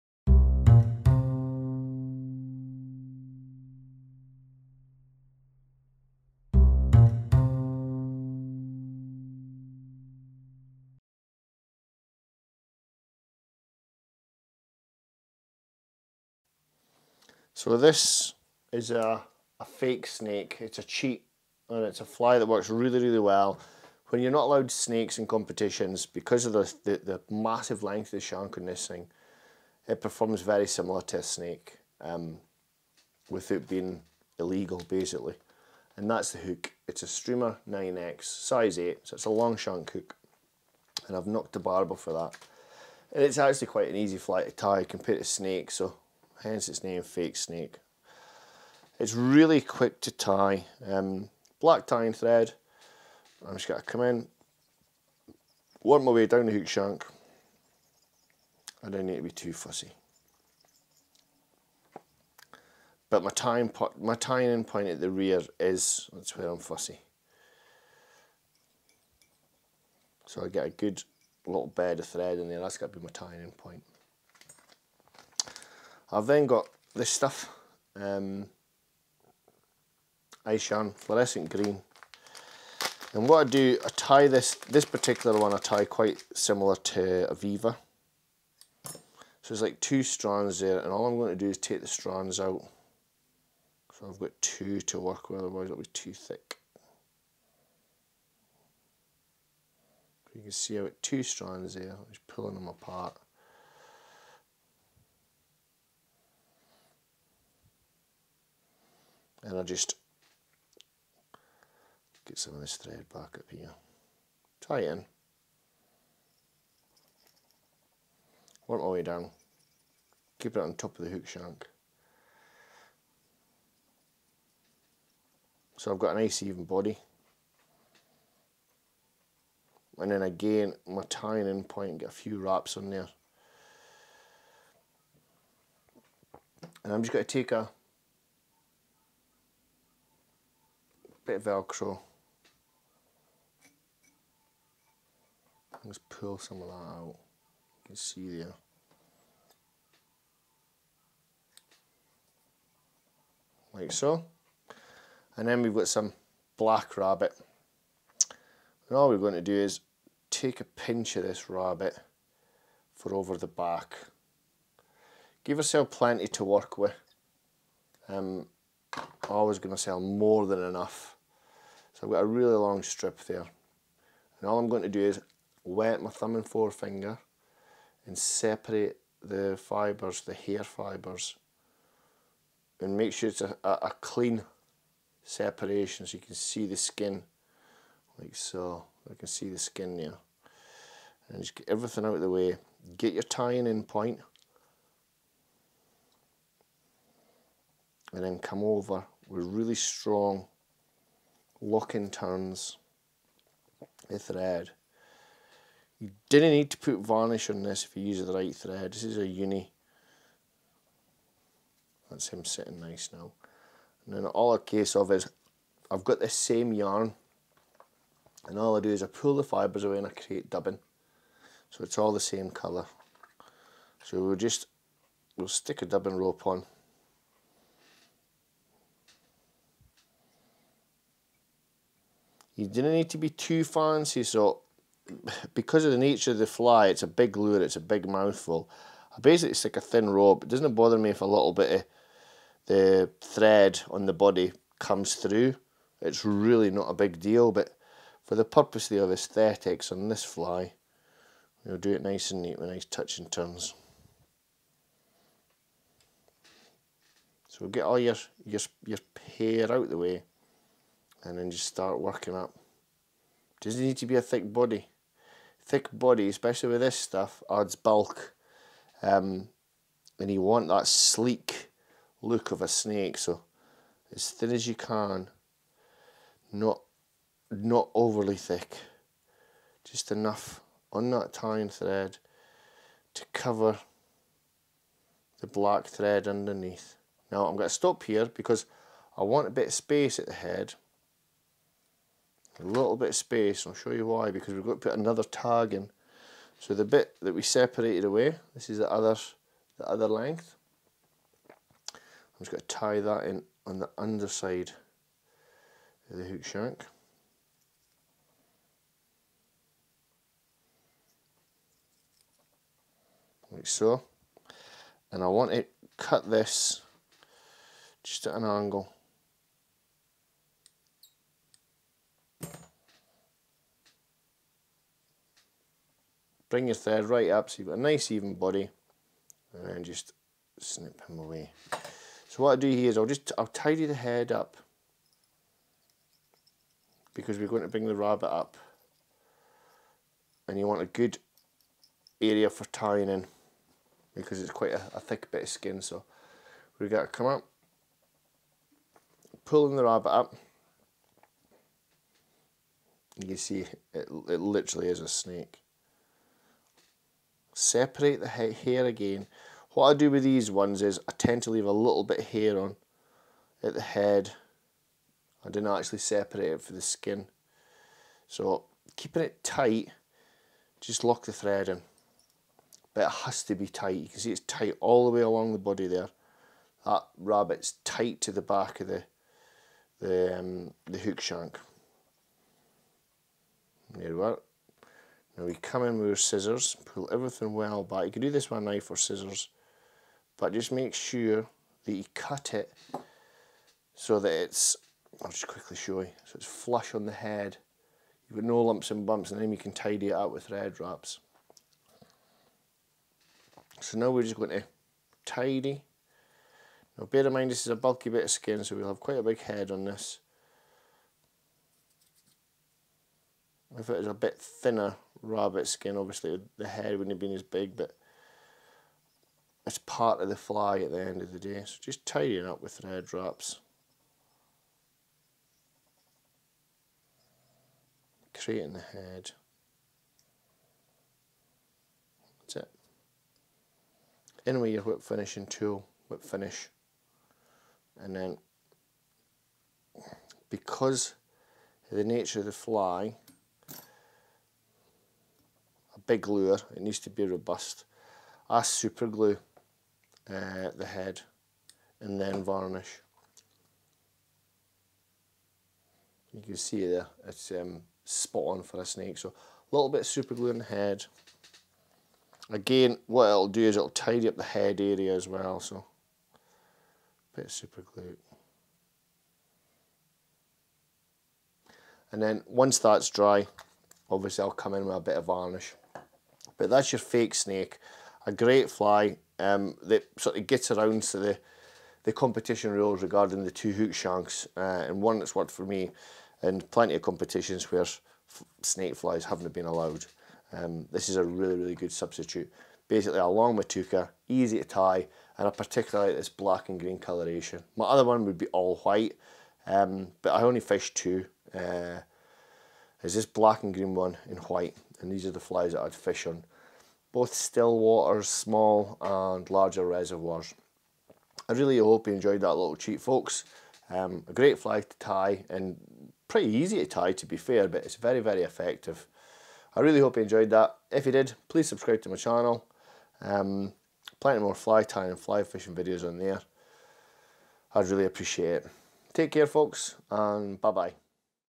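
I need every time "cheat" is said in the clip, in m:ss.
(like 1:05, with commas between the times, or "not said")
0:20, 8:32.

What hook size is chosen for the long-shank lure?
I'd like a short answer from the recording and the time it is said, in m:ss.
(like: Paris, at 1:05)
8, at 0:38.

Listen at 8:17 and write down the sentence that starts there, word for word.
My other one would be all white, um, but I only fished two.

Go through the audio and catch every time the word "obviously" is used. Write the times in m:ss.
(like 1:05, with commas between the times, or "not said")
6:55, 7:54.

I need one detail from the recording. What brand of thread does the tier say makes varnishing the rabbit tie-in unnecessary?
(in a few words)
Uni.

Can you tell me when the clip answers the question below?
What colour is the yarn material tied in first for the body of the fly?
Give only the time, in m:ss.
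1:20.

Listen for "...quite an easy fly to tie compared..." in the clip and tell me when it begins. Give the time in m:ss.
0:43.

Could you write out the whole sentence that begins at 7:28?
I super glue uh, the head and then varnish.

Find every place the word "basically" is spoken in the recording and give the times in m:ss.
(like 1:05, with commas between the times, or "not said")
0:34, 3:59, 8:12.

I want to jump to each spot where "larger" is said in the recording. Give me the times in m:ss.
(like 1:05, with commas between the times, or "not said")
8:29.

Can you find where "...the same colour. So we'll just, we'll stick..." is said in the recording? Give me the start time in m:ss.
3:42.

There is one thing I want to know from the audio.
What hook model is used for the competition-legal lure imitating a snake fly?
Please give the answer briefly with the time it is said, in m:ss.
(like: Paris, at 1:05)
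Streamer 9X, at 0:37.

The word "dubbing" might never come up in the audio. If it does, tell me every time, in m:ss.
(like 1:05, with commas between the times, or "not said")
3:40, 3:45.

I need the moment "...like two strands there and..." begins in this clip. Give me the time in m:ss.
1:29.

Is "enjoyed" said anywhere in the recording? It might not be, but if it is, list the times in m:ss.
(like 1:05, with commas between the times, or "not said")
8:32, 8:40.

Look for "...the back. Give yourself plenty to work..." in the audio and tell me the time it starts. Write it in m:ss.
2:43.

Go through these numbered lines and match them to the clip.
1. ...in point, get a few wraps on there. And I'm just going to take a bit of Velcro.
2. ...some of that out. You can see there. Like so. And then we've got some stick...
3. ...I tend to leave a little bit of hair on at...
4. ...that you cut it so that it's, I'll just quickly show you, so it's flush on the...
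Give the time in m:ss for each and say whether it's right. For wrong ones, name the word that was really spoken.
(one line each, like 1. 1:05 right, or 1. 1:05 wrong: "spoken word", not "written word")
1. 2:11 right
2. 2:26 wrong: "black", not "stick"
3. 6:01 right
4. 6:31 right.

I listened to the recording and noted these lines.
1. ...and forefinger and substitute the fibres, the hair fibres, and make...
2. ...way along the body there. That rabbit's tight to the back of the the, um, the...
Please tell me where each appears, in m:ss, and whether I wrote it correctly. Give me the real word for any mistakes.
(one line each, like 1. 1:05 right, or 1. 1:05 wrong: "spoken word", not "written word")
1. 2:56 wrong: "separate", not "substitute"
2. 6:15 right.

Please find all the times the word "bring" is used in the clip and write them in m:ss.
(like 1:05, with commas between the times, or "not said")
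5:26, 5:37.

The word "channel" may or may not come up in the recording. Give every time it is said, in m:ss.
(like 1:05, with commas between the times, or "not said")
8:42.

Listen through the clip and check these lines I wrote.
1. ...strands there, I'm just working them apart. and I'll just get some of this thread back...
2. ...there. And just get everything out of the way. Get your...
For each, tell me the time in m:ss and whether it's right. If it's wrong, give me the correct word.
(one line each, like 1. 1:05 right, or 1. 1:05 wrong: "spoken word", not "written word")
1. 1:41 wrong: "pulling", not "working"
2. 3:09 right.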